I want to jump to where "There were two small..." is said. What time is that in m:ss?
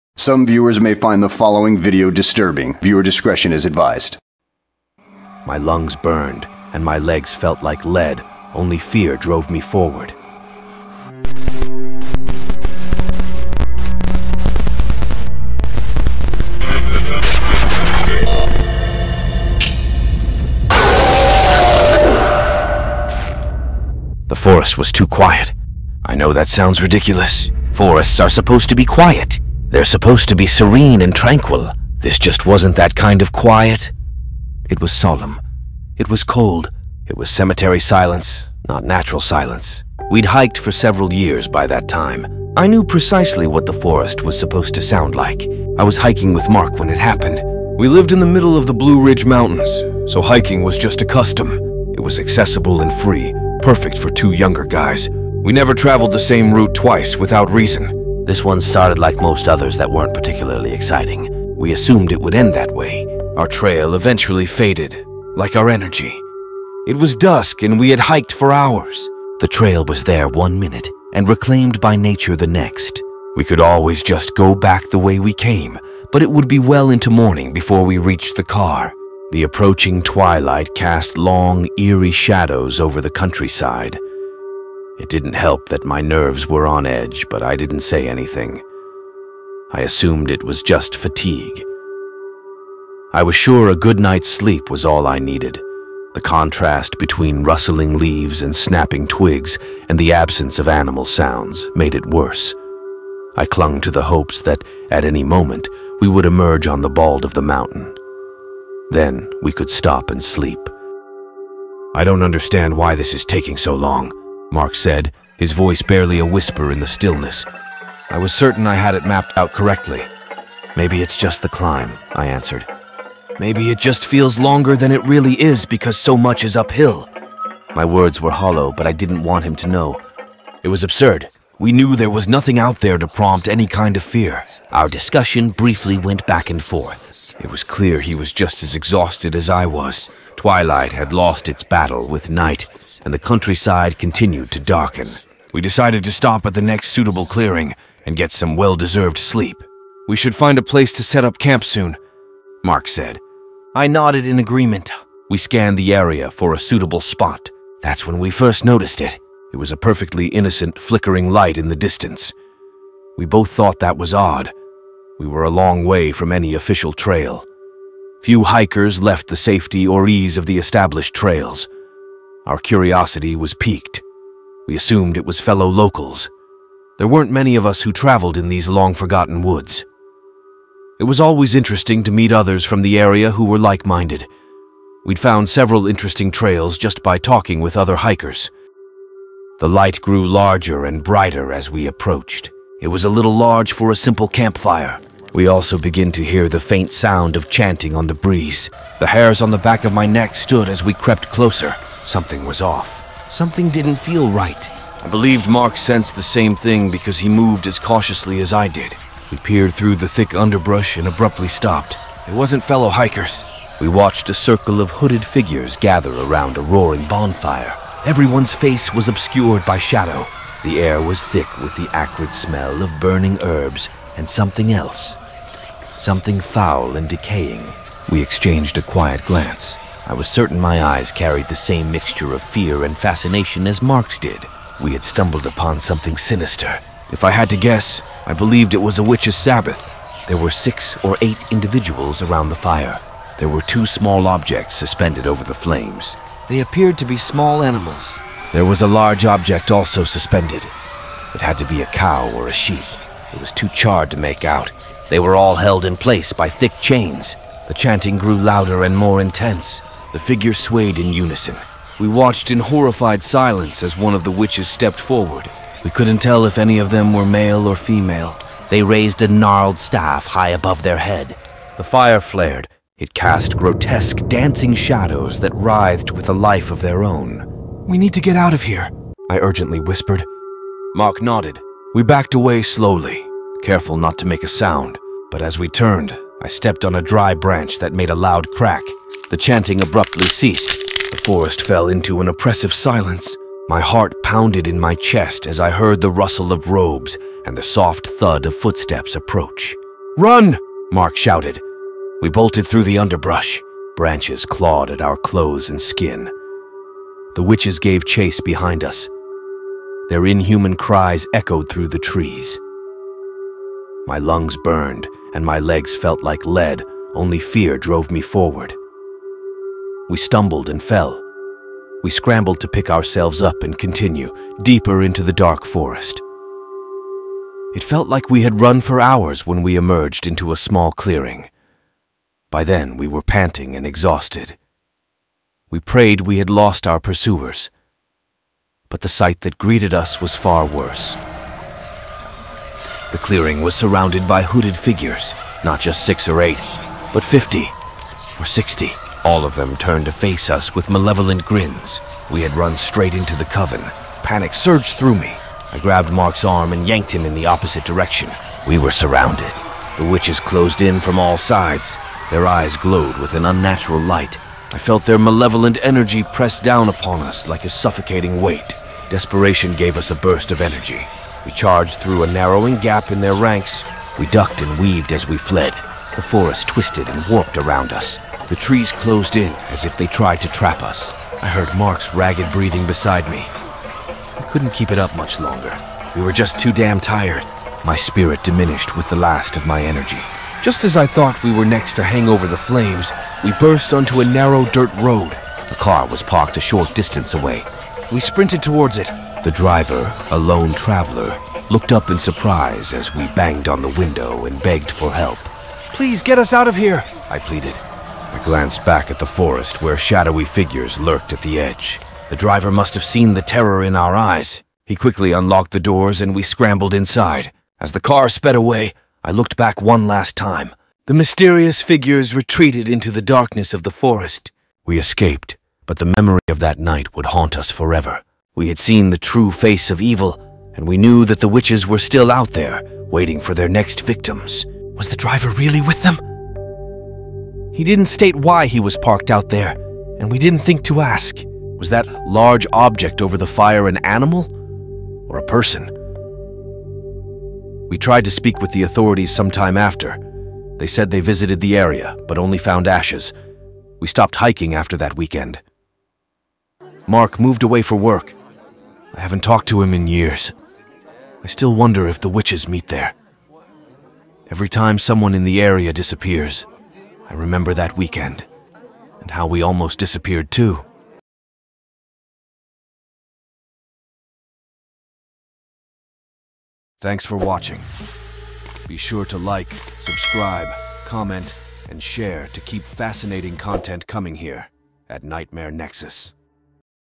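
4:03.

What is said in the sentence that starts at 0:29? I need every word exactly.
They're supposed to be serene and tranquil.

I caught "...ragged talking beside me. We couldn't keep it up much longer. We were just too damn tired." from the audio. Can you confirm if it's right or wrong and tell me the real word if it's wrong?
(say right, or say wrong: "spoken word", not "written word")
wrong: "breathing", not "talking".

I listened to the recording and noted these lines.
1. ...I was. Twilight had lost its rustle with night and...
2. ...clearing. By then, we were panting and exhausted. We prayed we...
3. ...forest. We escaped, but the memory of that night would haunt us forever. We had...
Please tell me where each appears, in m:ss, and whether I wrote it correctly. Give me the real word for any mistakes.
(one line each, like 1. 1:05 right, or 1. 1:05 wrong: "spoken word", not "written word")
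1. 2:19 wrong: "battle", not "rustle"
2. 5:30 right
3. 7:03 right.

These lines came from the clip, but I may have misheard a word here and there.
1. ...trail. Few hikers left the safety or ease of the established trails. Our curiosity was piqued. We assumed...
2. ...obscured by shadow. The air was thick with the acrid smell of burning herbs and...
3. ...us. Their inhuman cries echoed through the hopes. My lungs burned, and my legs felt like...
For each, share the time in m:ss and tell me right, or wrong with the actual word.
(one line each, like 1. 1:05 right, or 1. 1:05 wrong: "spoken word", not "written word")
1. 2:46 right
2. 3:39 right
3. 5:08 wrong: "trees", not "hopes".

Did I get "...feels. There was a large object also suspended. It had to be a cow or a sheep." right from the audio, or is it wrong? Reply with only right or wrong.
wrong.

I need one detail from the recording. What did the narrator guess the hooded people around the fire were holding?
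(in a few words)
witch's Sabbath.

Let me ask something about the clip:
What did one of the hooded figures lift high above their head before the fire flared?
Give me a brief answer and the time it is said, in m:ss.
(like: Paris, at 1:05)
a gnarled staff, at 4:29.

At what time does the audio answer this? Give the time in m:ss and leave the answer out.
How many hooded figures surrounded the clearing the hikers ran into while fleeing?
5:47.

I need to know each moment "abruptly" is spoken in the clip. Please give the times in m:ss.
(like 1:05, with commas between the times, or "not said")
3:31, 4:49.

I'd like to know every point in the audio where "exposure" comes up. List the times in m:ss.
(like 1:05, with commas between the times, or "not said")
not said.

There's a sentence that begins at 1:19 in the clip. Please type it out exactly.
The approaching twilight cast long, eerie shadows over the countryside.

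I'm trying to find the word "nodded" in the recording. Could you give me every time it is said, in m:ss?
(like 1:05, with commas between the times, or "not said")
2:33, 4:41.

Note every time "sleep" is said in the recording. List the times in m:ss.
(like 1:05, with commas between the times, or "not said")
1:34, 1:50, 2:29.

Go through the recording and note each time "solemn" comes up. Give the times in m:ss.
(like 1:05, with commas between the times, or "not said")
0:34.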